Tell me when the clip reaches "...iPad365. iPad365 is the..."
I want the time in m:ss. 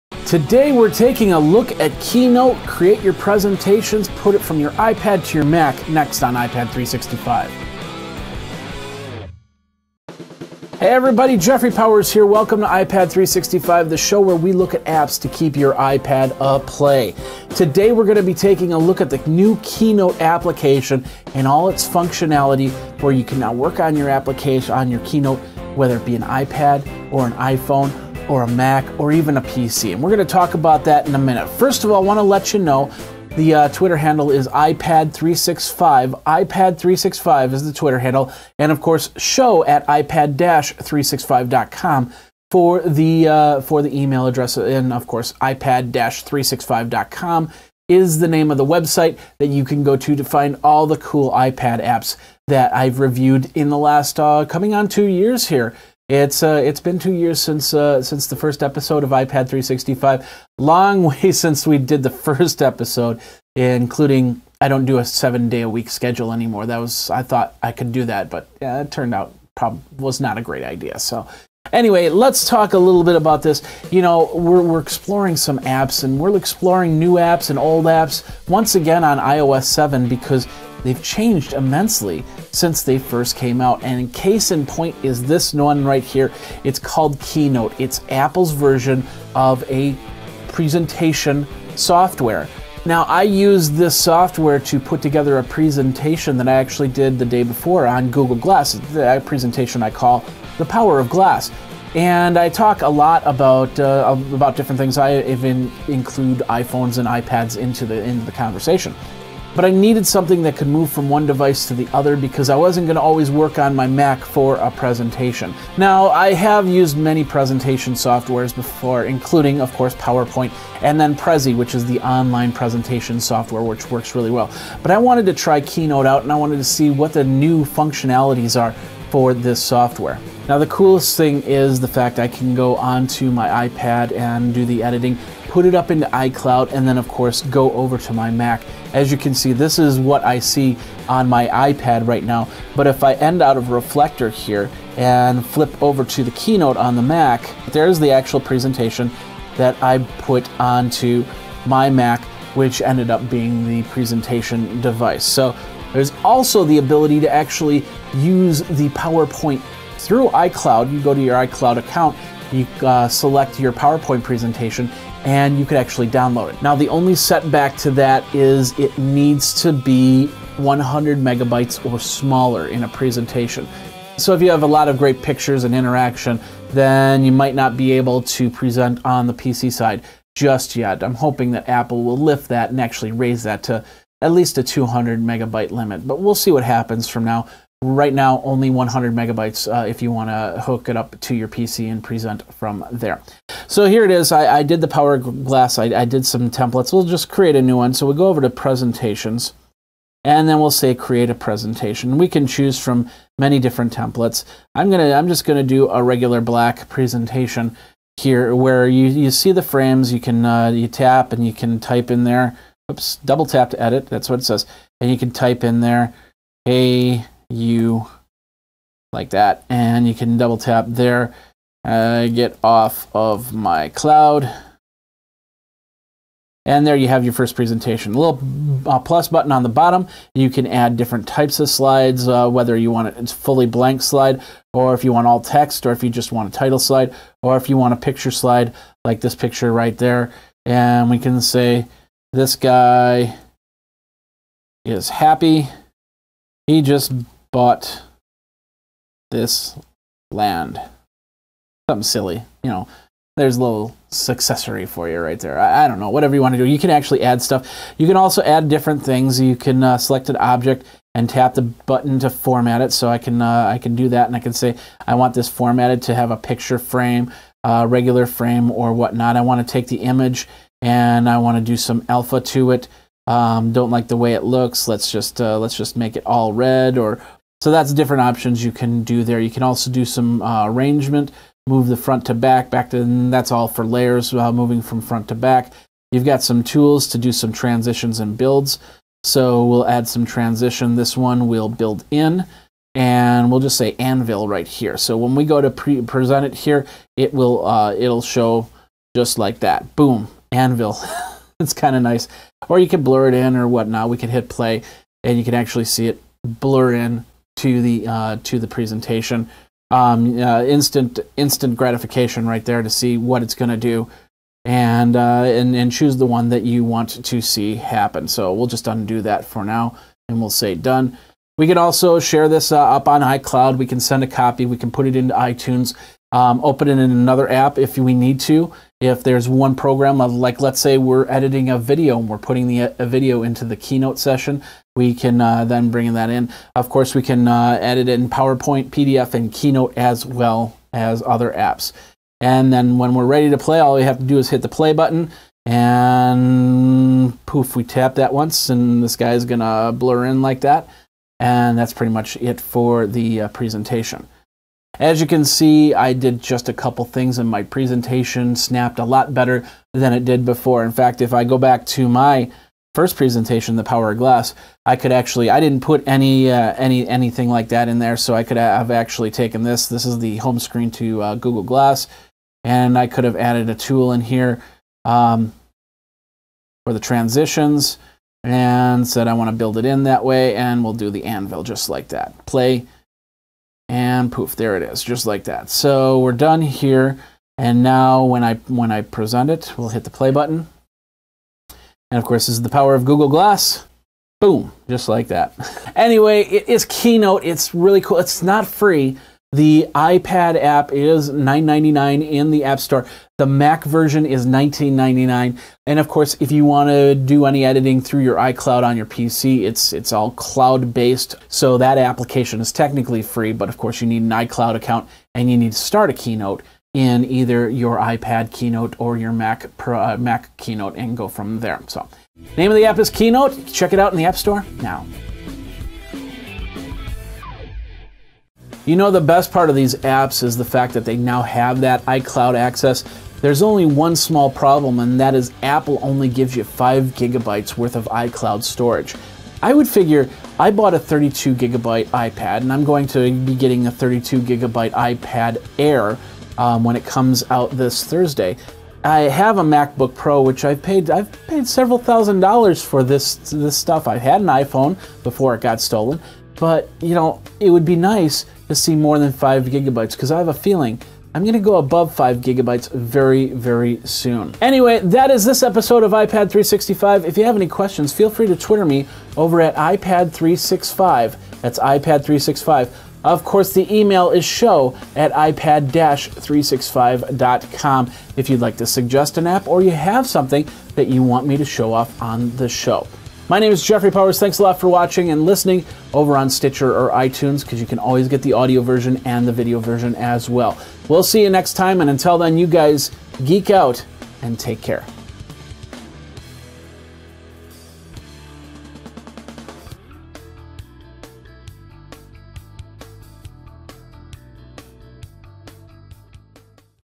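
0:34.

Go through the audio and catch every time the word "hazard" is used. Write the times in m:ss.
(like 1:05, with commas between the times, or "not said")
not said.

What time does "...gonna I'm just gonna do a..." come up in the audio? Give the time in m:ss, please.
3:24.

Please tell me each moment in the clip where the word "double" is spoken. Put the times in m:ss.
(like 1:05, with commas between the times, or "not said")
3:33, 3:40.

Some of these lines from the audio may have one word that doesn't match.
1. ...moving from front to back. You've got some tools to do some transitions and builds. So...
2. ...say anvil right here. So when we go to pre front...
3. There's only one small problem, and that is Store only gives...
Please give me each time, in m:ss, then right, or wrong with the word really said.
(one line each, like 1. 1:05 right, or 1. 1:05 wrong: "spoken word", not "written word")
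1. 4:44 right
2. 4:53 wrong: "present", not "front"
3. 7:13 wrong: "Apple", not "Store".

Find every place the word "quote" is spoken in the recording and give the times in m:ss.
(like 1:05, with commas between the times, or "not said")
not said.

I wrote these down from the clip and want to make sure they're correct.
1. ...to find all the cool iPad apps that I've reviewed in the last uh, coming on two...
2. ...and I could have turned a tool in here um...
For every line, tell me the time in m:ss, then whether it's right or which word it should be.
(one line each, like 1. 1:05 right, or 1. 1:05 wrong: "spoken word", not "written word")
1. 0:50 right
2. 6:12 wrong: "added", not "turned".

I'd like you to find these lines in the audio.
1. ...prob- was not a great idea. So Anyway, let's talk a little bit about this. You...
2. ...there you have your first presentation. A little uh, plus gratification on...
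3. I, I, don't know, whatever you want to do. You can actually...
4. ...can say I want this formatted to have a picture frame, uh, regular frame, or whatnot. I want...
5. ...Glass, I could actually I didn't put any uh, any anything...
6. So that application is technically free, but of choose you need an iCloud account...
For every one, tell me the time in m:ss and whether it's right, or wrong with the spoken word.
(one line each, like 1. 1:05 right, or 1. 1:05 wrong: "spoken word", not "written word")
1. 1:09 right
2. 3:46 wrong: "button", not "gratification"
3. 4:15 right
4. 4:24 right
5. 6:04 right
6. 6:51 wrong: "course", not "choose".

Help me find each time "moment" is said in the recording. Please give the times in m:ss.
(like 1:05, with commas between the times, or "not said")
not said.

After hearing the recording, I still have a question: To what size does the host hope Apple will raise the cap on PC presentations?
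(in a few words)
200 megabytes.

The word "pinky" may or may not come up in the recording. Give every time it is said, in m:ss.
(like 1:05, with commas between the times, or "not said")
not said.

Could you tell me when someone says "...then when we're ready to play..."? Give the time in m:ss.
5:42.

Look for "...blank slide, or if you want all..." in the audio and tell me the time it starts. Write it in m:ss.
3:53.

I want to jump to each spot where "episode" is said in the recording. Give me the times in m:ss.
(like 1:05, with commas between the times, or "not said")
0:58, 1:02, 7:45.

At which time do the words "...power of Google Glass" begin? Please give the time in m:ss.
6:32.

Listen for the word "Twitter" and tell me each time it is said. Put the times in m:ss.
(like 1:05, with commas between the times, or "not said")
0:33, 0:37, 7:48.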